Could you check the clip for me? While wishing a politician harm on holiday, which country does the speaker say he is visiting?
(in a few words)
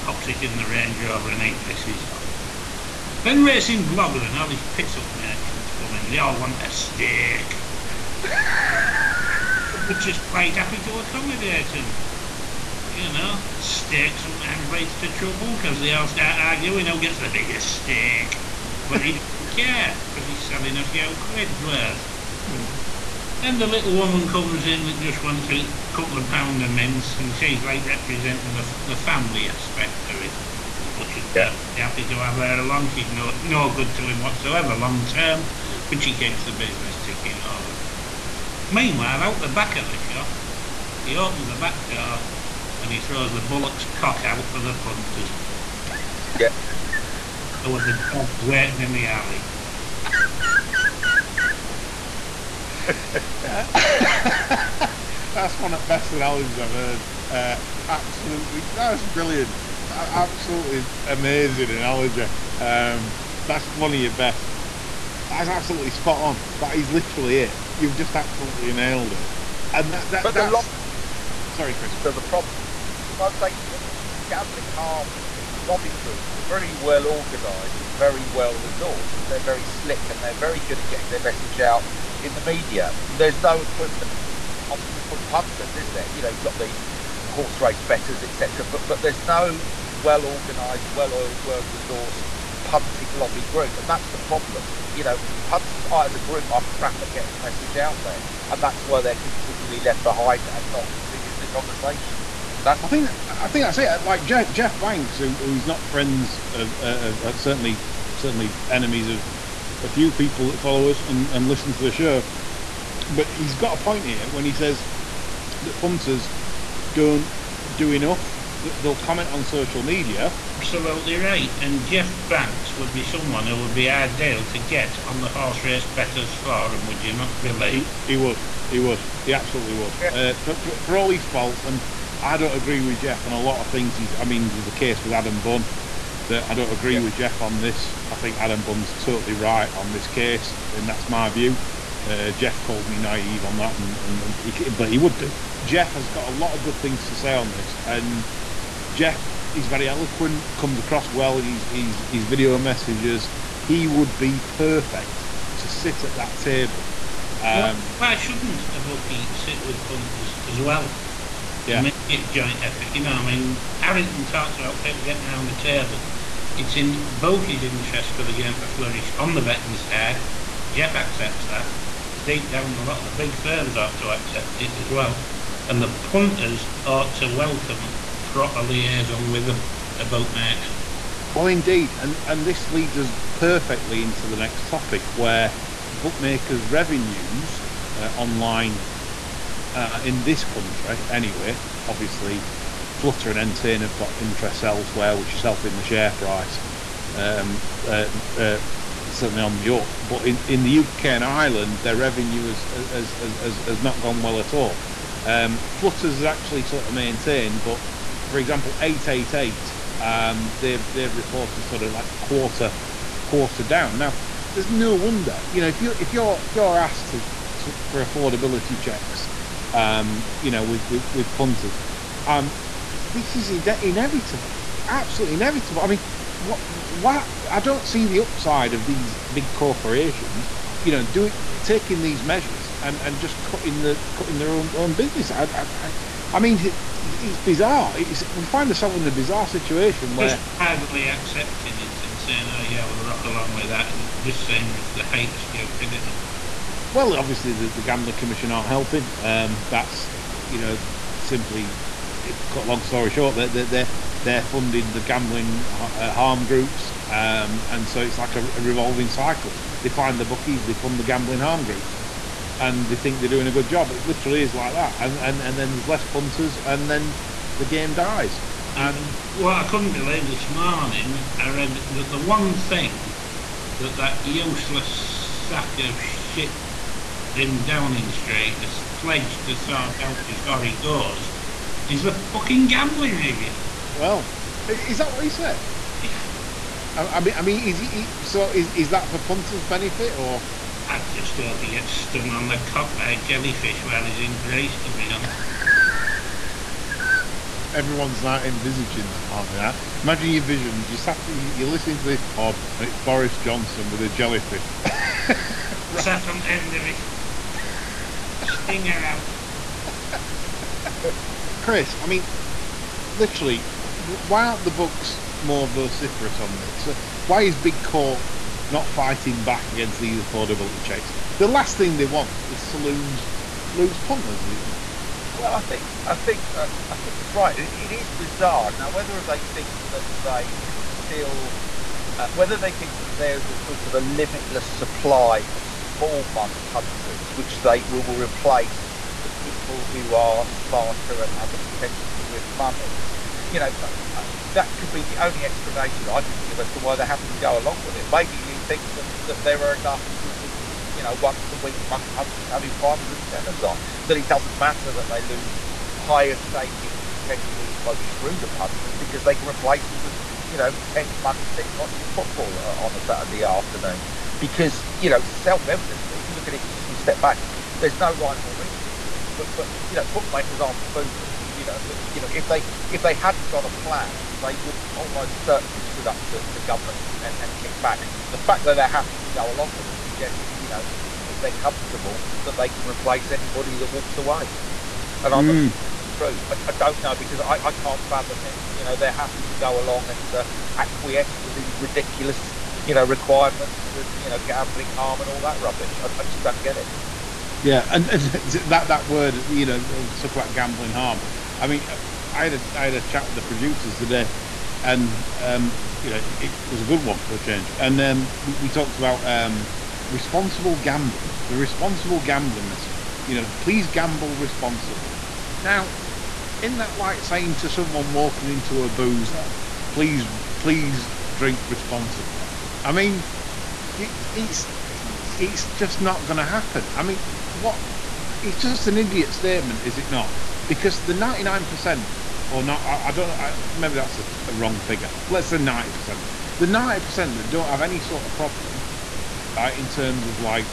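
Greece.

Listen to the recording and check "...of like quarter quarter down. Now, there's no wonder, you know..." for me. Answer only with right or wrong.
right.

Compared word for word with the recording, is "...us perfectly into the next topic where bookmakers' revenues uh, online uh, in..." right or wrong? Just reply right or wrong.
right.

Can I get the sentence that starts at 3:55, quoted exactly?
I, I, I mean, it's bizarre.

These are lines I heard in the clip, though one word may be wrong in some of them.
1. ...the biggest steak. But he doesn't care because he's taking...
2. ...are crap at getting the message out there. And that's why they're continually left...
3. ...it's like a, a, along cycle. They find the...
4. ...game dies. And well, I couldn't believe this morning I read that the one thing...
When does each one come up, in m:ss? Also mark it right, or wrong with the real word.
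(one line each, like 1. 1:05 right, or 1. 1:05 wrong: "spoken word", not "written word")
1. 0:17 wrong: "selling", not "taking"
2. 1:36 right
3. 4:18 wrong: "revolving", not "along"
4. 4:27 right.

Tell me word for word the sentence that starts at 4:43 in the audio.
Well, is that what he said?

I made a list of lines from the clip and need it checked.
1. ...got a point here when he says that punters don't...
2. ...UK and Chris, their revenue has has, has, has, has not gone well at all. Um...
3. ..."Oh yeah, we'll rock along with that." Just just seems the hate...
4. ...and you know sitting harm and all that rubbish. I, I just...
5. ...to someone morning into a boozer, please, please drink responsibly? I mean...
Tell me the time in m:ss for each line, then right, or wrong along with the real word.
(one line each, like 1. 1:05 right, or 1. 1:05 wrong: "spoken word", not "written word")
1. 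1:53 right
2. 3:20 wrong: "Ireland", not "Chris"
3. 4:02 right
4. 6:33 wrong: "gambling", not "sitting"
5. 6:57 wrong: "walking", not "morning".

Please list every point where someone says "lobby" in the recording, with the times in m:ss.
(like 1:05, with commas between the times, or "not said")
1:15, 1:33.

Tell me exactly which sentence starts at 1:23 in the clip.
There's no equivalent from punters, is there?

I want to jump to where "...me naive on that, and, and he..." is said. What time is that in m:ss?
2:22.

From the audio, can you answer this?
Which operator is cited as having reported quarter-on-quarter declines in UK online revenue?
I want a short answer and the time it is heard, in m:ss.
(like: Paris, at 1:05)
888, at 3:28.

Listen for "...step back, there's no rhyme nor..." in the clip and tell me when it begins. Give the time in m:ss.
6:07.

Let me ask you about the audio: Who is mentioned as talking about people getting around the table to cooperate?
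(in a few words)
Harrington.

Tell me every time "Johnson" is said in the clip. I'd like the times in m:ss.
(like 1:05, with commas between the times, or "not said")
5:03.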